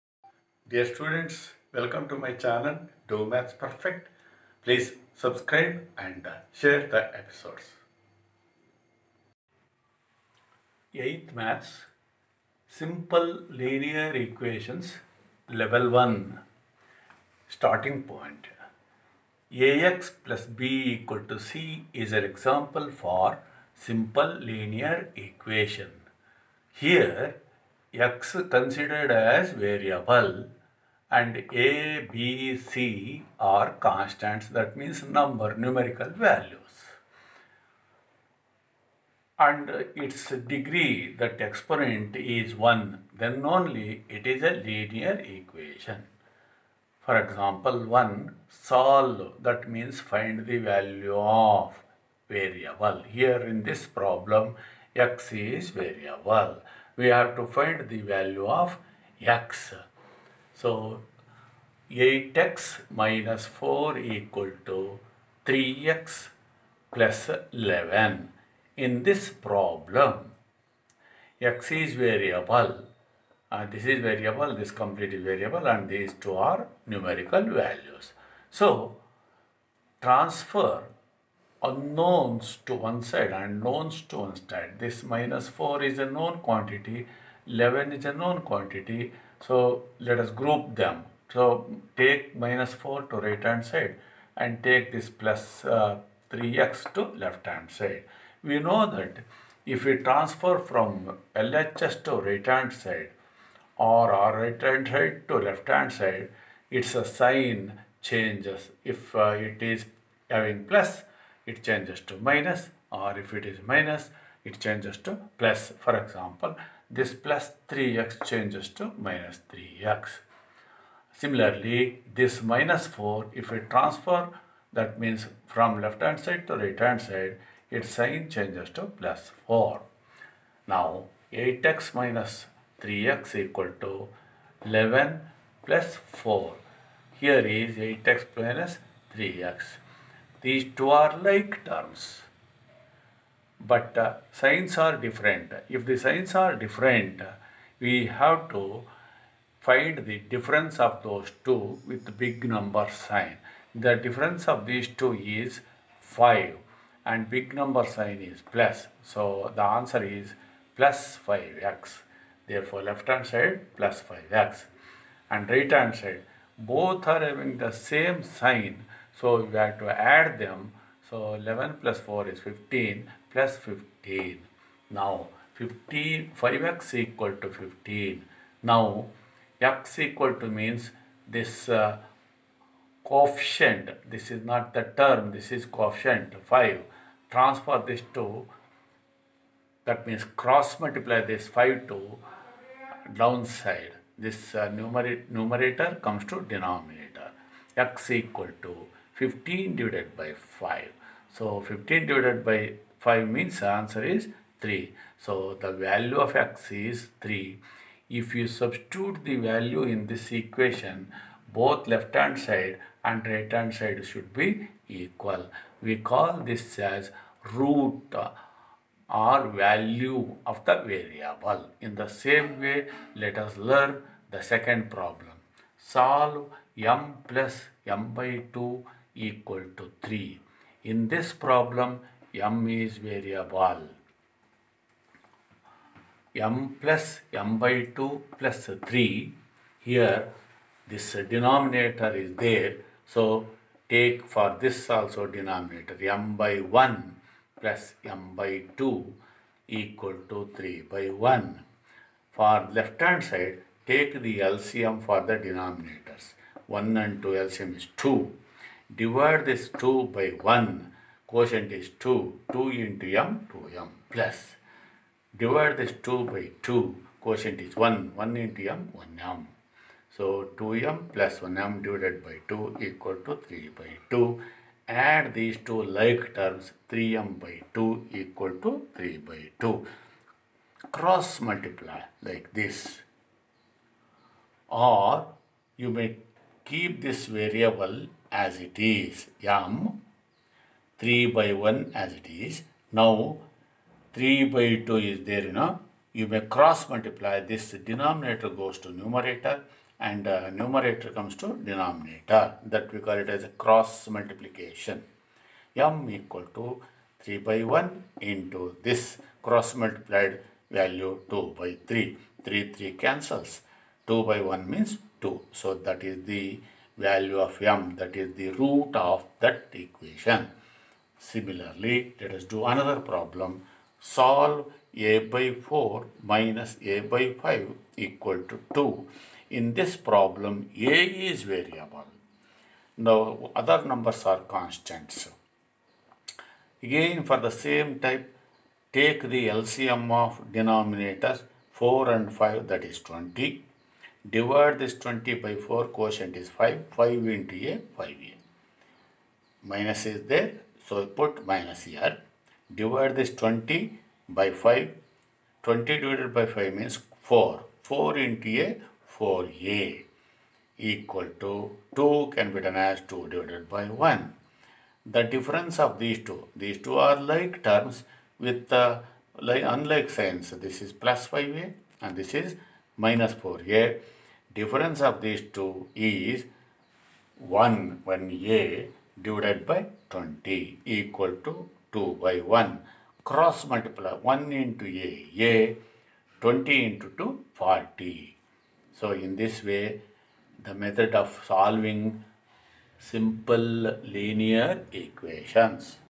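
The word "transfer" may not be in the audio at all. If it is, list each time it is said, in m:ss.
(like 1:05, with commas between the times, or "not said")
1:20, 1:39, 2:03, 3:07.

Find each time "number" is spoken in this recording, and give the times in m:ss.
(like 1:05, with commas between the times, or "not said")
0:35, 2:32, 2:37, 5:33.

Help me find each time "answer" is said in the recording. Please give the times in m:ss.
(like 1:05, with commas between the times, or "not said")
2:39, 3:23.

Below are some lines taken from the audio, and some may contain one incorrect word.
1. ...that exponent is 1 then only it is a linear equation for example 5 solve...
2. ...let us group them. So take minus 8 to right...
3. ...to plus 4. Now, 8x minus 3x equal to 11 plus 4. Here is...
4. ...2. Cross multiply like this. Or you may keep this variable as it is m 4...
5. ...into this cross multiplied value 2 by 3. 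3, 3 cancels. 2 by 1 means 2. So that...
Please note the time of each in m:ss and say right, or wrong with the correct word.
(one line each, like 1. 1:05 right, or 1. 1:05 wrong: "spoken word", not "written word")
1. 0:41 wrong: "1", not "5"
2. 1:29 wrong: "4", not "8"
3. 2:08 right
4. 4:39 wrong: "3", not "4"
5. 5:08 right.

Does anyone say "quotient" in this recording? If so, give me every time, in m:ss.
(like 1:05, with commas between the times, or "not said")
4:21, 4:27, 5:45.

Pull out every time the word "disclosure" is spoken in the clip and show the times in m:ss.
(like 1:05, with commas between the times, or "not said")
not said.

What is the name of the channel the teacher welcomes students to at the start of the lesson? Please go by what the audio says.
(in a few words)
Do Maths Perfect.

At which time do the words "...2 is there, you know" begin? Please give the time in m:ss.
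4:54.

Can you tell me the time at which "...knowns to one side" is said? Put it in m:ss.
1:23.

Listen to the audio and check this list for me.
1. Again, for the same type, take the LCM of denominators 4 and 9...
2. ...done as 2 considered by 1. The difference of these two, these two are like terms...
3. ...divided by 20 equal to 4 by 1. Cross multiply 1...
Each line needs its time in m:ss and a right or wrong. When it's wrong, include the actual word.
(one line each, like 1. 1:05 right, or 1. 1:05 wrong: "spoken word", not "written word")
1. 5:36 wrong: "5", not "9"
2. 6:02 wrong: "divided", not "considered"
3. 6:19 wrong: "2", not "4".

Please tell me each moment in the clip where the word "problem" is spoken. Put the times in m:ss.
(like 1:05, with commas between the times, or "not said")
0:53, 1:09, 3:44, 3:51, 5:22, 5:29.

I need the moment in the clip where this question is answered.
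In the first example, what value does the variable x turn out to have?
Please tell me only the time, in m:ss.
3:23.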